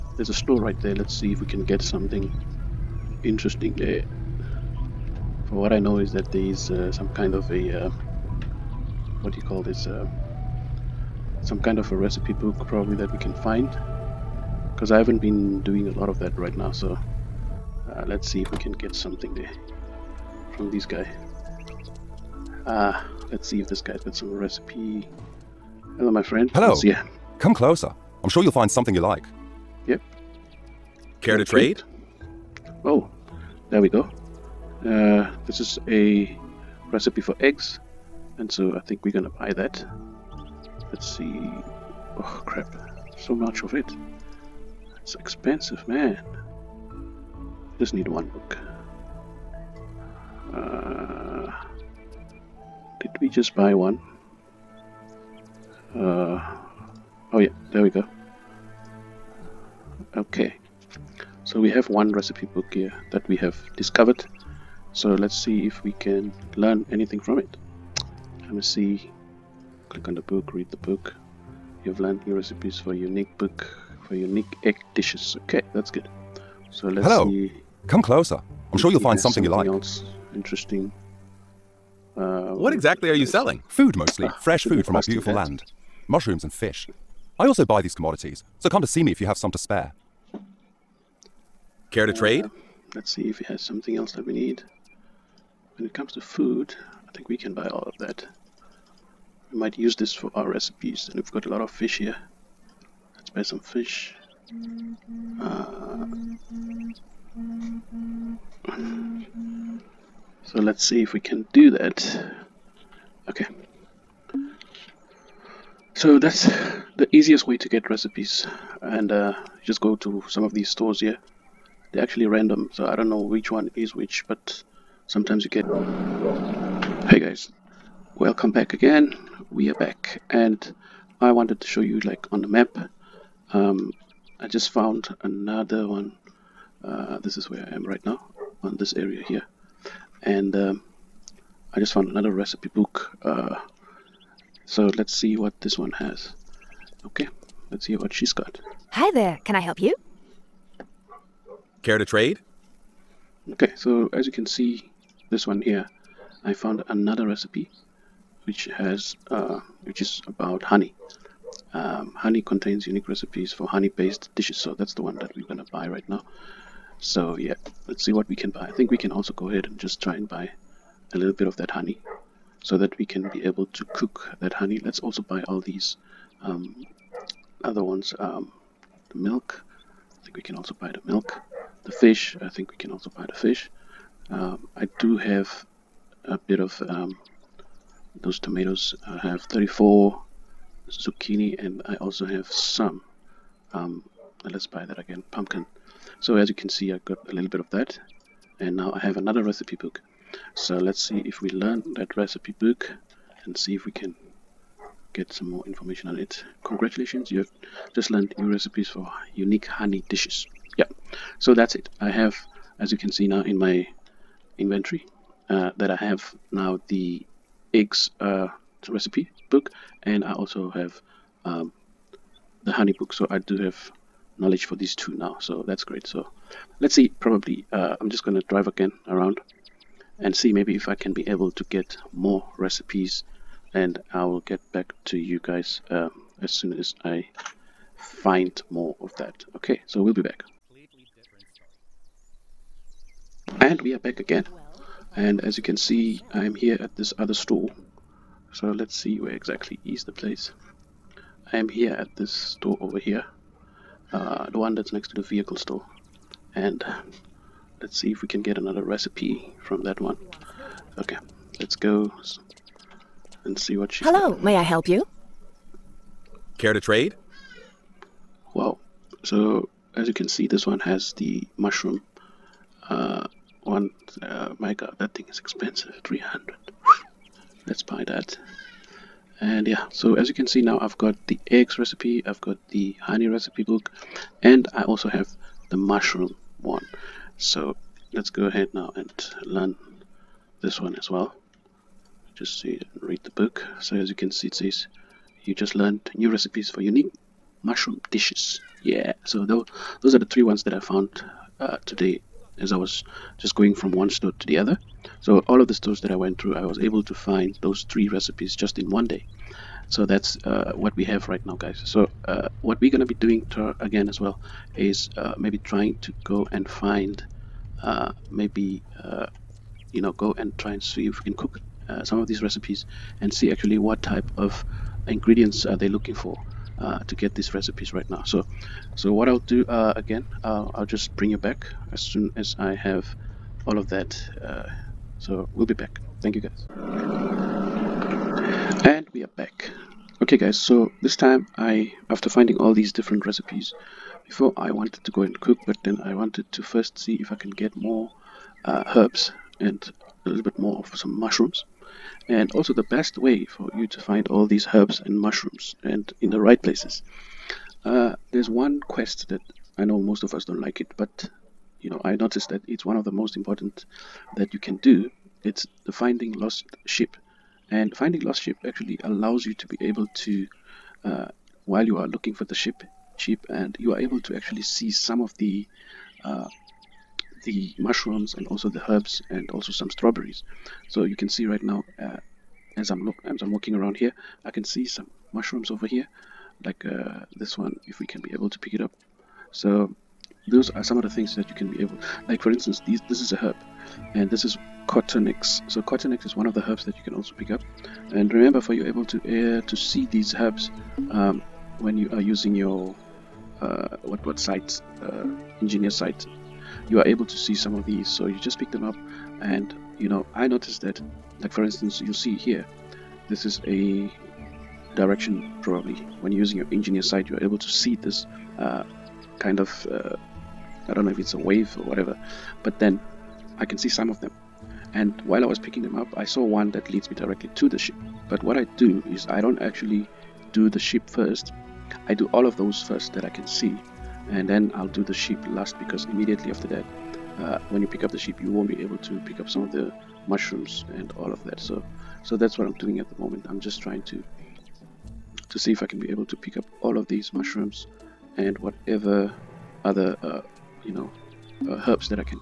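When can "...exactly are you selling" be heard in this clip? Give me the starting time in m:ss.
1:22.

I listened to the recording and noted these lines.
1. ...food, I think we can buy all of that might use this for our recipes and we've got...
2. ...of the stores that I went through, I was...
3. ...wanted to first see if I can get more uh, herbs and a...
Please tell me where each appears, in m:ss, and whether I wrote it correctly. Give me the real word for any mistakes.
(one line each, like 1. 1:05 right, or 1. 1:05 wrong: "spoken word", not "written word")
1. 1:36 right
2. 5:05 right
3. 5:46 right.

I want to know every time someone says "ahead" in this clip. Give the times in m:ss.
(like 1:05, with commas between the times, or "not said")
2:49, 4:48.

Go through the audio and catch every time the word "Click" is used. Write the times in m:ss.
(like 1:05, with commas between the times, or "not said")
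1:09.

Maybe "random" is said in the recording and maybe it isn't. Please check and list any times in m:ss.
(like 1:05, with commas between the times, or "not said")
2:02.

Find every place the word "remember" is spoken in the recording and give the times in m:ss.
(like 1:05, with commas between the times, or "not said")
6:38.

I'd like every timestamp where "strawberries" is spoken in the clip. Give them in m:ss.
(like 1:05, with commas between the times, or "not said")
6:19.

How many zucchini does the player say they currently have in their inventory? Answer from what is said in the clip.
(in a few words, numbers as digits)
34.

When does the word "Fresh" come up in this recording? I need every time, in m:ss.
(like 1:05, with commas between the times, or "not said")
1:24.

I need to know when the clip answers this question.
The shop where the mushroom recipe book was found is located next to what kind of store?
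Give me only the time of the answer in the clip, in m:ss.
4:15.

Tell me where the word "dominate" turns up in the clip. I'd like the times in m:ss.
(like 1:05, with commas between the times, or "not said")
not said.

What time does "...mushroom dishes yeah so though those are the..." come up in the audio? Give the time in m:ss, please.
4:57.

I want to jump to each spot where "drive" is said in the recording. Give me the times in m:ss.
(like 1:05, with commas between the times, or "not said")
3:48.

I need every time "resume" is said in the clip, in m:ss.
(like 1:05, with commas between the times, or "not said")
not said.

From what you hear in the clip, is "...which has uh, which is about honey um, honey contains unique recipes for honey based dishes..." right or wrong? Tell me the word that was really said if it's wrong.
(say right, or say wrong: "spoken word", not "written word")
right.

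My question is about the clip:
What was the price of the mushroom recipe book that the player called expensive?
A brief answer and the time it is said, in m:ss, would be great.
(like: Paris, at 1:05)
300, at 4:36.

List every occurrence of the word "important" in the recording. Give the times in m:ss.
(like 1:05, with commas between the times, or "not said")
6:03.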